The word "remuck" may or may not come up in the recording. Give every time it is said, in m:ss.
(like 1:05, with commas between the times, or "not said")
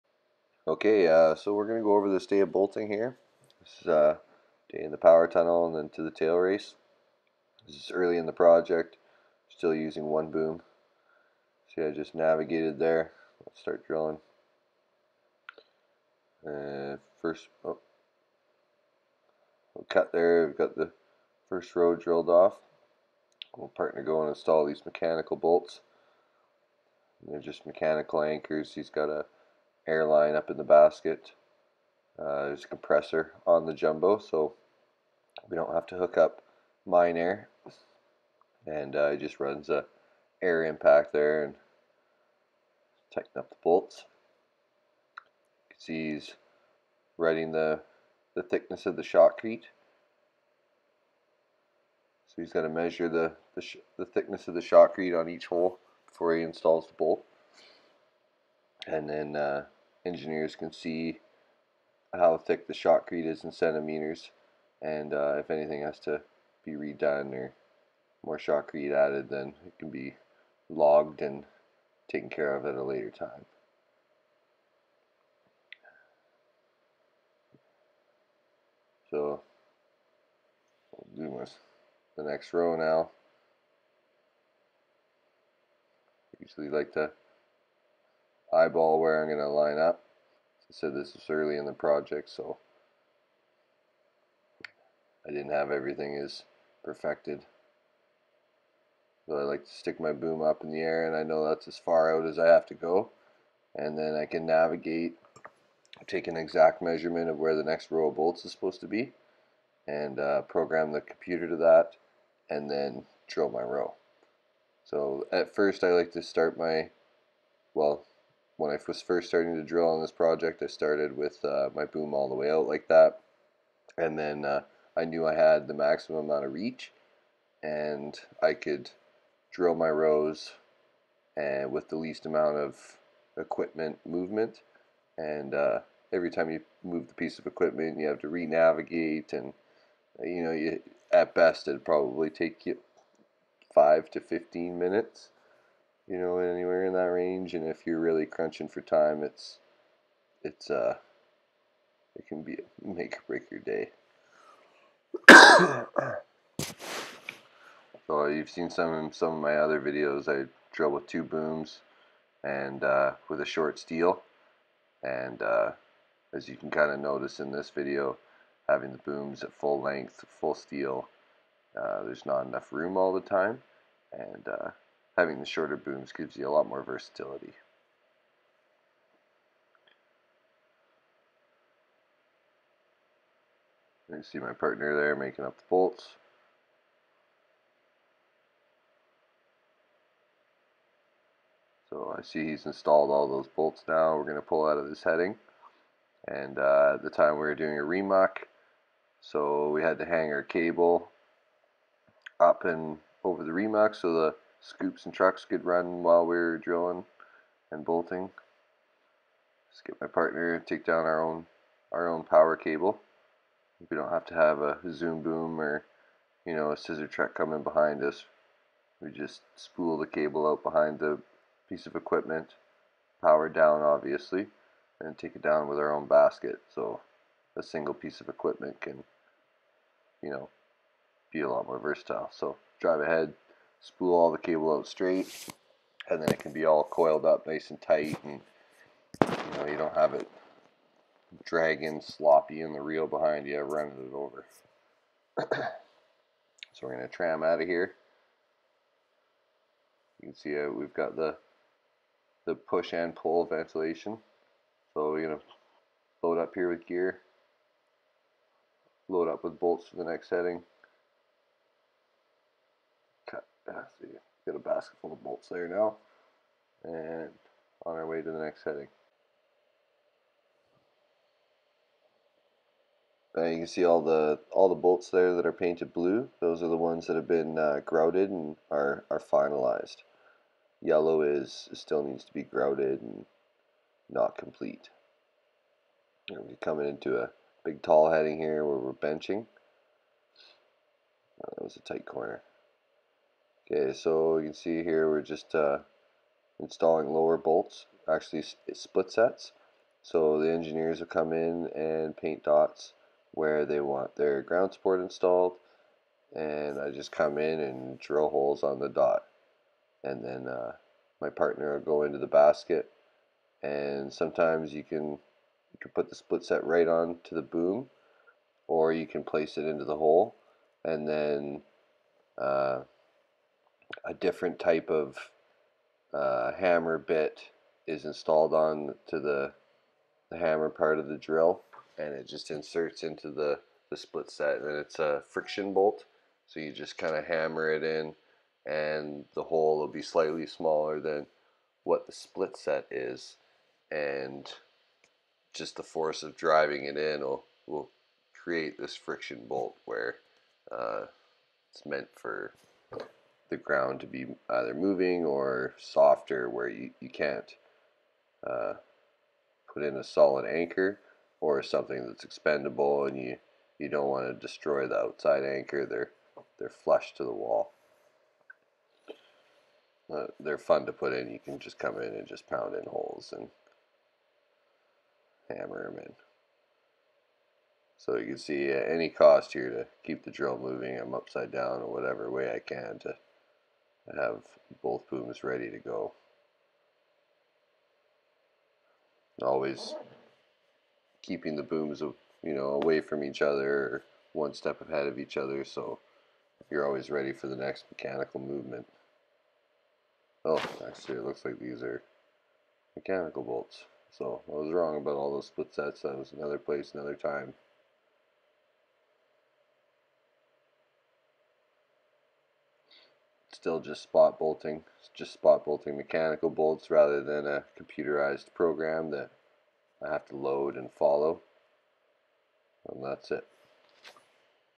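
3:17, 3:23.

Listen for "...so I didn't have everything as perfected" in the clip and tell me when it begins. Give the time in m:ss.
1:32.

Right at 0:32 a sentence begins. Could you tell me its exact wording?
Uh, there's a compressor on the jumbo, so we don't have to hook up mine air.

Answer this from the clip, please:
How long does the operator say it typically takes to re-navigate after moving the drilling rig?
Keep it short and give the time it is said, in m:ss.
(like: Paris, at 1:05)
5 to 15 minutes, at 2:23.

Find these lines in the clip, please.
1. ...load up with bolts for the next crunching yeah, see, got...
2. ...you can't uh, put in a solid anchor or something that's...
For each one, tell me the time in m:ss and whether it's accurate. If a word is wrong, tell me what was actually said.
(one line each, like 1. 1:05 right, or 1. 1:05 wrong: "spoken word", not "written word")
1. 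4:19 wrong: "setting", not "crunching"
2. 5:57 right.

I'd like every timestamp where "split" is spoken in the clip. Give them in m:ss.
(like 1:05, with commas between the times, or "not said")
4:58, 5:16, 5:33, 5:42, 6:45.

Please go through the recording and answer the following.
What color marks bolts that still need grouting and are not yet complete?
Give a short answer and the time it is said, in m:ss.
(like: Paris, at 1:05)
yellow, at 4:40.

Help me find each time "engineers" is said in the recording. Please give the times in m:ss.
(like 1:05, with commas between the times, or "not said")
1:00, 5:00.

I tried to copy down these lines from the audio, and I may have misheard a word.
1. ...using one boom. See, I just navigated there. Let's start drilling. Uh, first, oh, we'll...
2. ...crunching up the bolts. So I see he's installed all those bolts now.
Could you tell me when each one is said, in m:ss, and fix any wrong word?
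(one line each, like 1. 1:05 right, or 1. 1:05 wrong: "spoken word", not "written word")
1. 0:09 right
2. 3:05 wrong: "making", not "crunching".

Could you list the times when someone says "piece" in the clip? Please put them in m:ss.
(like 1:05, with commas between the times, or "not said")
2:17, 3:41, 3:47.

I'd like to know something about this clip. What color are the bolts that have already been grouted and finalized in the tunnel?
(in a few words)
blue.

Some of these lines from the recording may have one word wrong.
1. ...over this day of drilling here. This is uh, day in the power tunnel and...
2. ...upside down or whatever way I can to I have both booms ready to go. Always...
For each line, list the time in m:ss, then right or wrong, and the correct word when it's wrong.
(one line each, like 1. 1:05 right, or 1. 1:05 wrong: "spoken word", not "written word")
1. 0:01 wrong: "bolting", not "drilling"
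2. 6:21 right.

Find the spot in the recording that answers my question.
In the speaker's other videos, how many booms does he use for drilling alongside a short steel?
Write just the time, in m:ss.
2:41.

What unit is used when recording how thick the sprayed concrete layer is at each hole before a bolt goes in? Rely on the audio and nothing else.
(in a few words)
centimeters.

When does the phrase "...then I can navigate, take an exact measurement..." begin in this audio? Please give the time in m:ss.
1:43.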